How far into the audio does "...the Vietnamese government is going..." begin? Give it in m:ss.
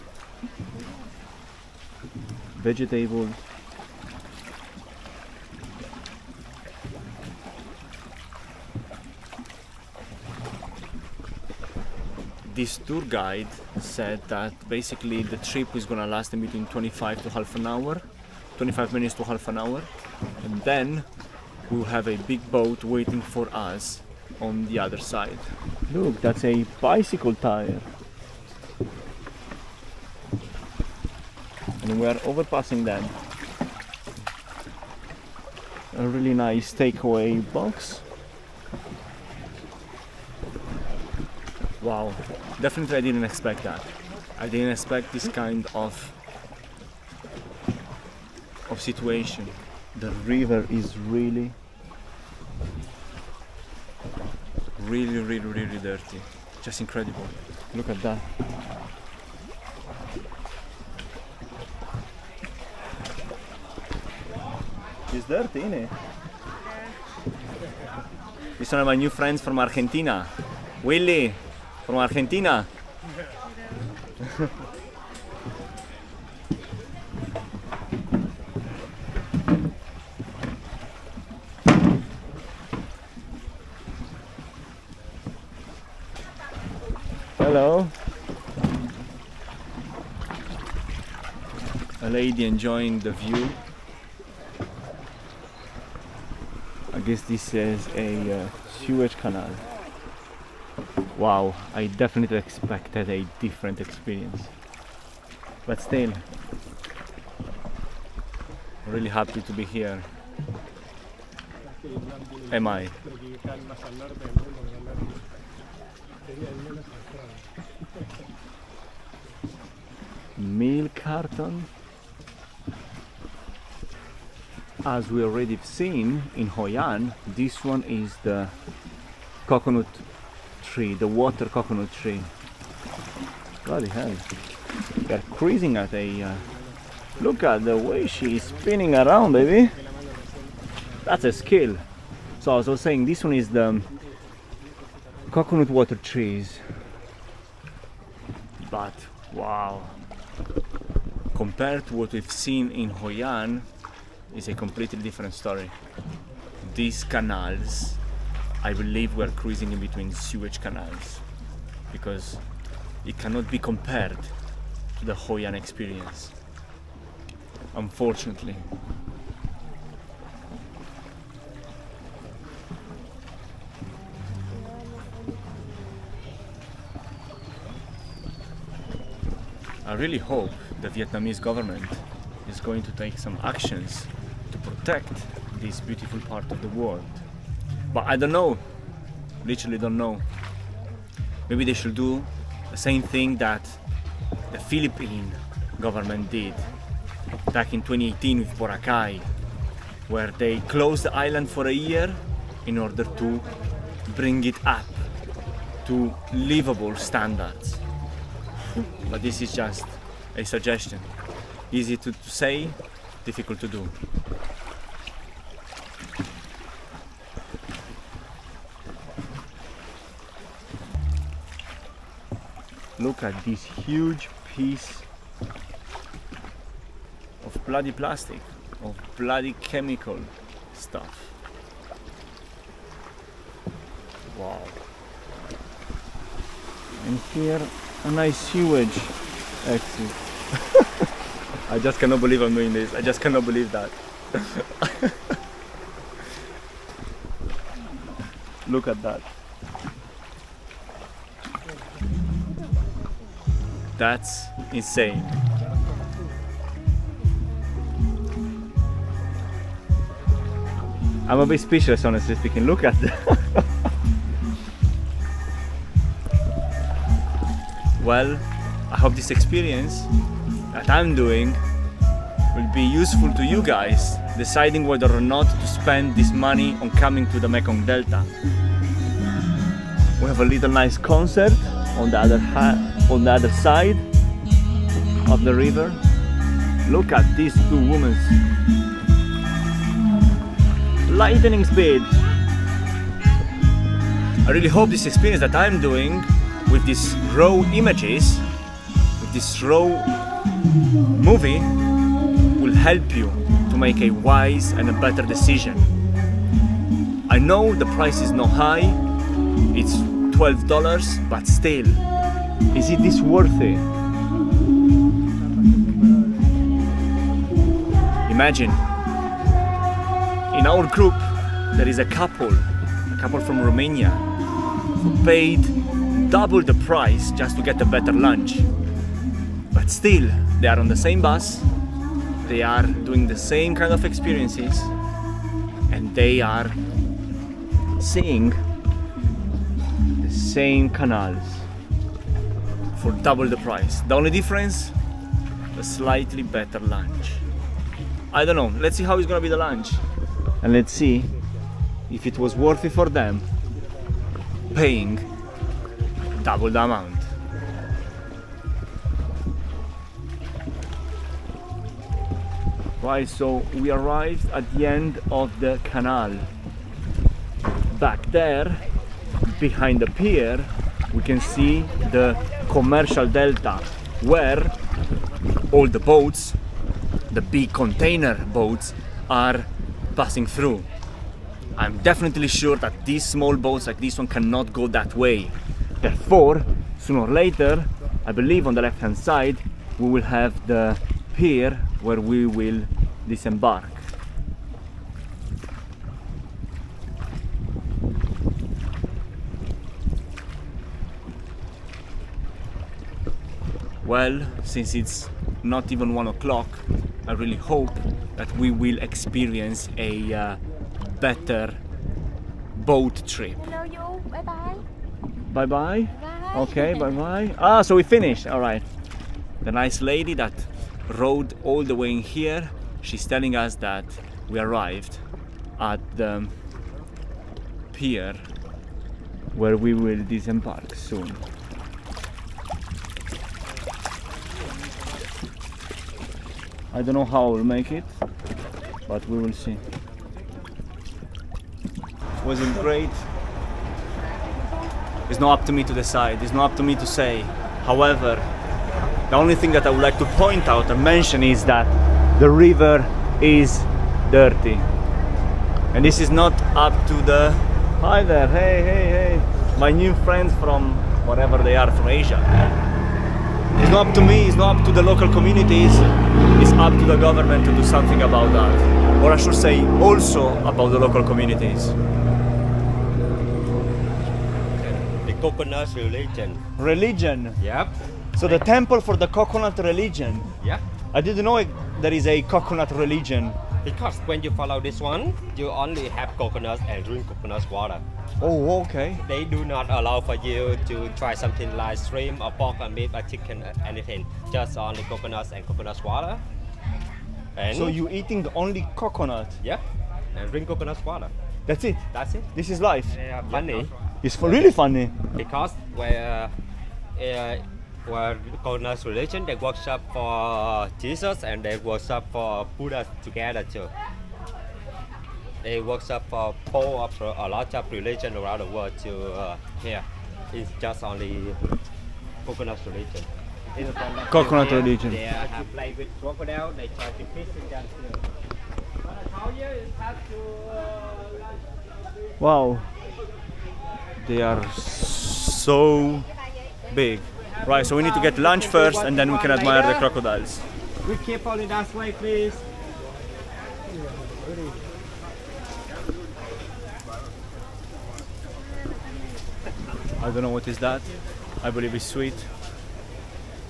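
3:00.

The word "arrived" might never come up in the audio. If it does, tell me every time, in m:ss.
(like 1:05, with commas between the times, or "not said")
6:03, 7:04.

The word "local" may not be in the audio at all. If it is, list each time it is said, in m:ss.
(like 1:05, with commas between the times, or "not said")
7:45, 7:51.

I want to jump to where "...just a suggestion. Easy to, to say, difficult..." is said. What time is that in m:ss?
3:29.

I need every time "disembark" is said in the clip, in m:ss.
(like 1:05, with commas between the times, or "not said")
6:33, 7:10.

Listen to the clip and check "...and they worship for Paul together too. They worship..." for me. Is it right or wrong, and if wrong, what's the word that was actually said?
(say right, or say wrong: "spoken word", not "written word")
wrong: "Buddha", not "Paul".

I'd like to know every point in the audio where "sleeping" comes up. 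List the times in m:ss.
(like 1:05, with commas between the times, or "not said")
not said.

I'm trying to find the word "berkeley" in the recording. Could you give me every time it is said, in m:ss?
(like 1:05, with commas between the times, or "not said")
not said.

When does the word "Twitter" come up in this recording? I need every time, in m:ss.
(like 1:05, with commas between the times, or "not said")
not said.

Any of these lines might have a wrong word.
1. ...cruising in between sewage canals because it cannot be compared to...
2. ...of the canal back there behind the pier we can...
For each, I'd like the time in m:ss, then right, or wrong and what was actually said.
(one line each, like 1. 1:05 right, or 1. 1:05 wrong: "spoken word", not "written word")
1. 2:39 right
2. 6:05 right.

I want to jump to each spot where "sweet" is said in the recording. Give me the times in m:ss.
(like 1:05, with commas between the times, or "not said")
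9:12.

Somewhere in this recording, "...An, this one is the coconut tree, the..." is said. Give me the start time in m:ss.
2:06.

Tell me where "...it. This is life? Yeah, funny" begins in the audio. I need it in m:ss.
8:22.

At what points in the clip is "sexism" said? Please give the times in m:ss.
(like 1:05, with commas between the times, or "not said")
not said.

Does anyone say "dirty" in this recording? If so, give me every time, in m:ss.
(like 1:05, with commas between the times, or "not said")
0:55, 1:05, 7:34.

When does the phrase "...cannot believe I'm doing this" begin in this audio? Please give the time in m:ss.
4:01.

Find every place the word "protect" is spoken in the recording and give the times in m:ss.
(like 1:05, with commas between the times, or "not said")
3:04.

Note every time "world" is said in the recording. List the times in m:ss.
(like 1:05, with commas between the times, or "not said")
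3:06, 8:38.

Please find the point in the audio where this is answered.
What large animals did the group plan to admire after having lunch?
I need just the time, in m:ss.
8:59.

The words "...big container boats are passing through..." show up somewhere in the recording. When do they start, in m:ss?
6:17.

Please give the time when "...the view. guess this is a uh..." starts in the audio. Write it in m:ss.
1:32.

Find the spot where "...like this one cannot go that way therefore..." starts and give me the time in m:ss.
6:23.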